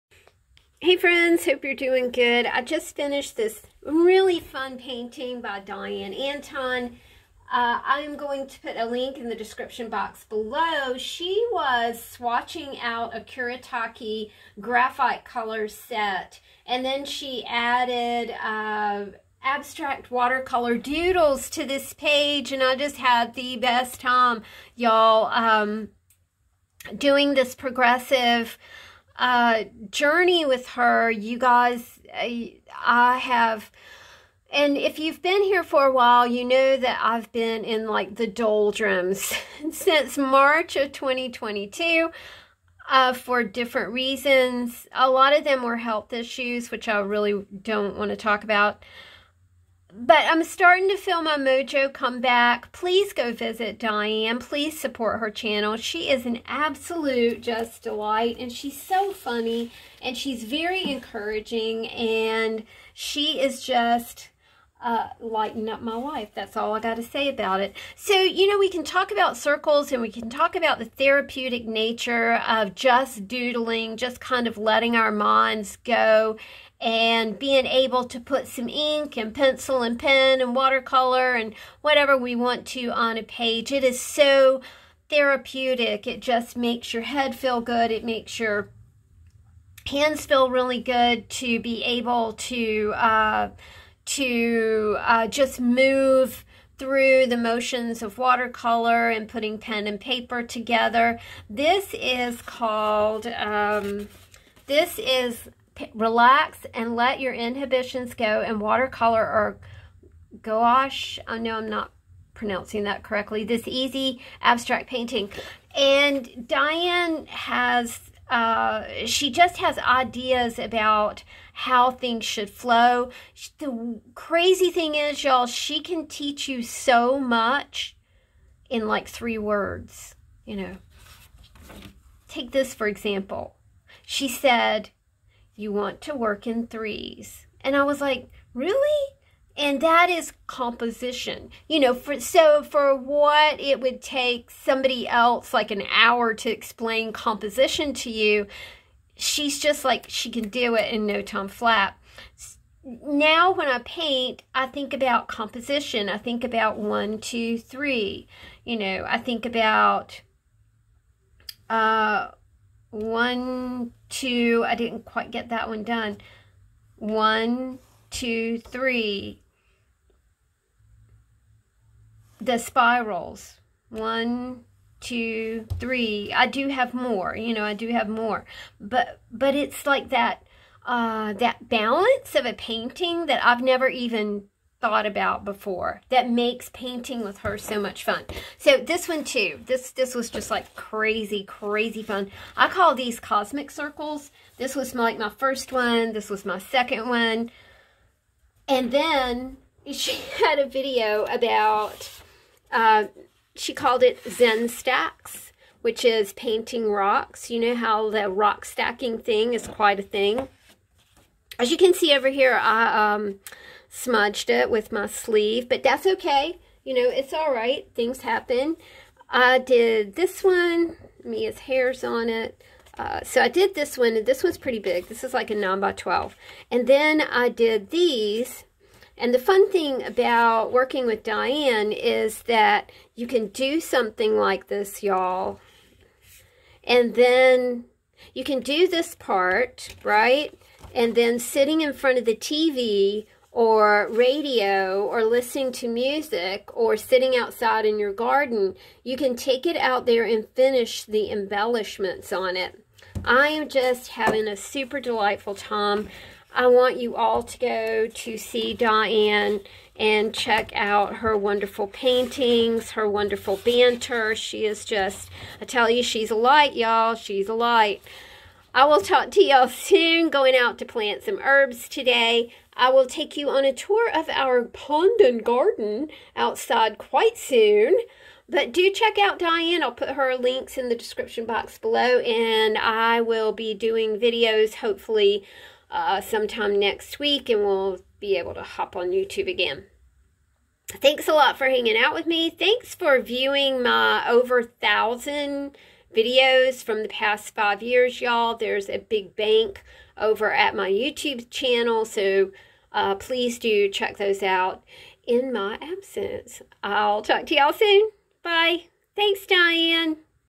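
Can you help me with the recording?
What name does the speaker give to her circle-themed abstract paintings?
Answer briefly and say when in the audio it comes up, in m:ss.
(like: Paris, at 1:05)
cosmic circles, at 3:13.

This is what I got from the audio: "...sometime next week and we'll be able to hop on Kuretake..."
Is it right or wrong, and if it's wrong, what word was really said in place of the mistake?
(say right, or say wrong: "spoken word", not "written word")
wrong: "YouTube", not "Kuretake".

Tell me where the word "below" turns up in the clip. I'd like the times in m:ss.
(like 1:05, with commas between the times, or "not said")
0:10, 4:41.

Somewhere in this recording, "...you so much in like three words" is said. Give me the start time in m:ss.
2:06.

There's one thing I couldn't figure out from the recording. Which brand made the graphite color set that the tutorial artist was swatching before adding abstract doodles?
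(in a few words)
Kuretake.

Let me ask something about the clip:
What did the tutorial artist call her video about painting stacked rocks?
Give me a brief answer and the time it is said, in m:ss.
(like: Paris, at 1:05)
Zen stacks, at 3:24.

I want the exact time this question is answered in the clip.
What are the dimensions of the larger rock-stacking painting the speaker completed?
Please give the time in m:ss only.
3:45.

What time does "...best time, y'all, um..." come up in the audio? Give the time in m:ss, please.
0:23.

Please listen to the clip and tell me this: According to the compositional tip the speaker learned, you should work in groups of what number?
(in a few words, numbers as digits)
3.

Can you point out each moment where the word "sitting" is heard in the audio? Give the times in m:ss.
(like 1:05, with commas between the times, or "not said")
4:01, 4:06.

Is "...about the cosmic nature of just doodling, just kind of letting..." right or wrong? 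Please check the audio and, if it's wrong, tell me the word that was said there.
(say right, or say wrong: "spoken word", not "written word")
wrong: "therapeutic", not "cosmic".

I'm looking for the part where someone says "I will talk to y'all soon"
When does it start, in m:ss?
4:28.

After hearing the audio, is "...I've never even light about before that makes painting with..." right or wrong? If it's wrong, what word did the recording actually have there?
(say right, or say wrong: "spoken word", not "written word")
wrong: "thought", not "light".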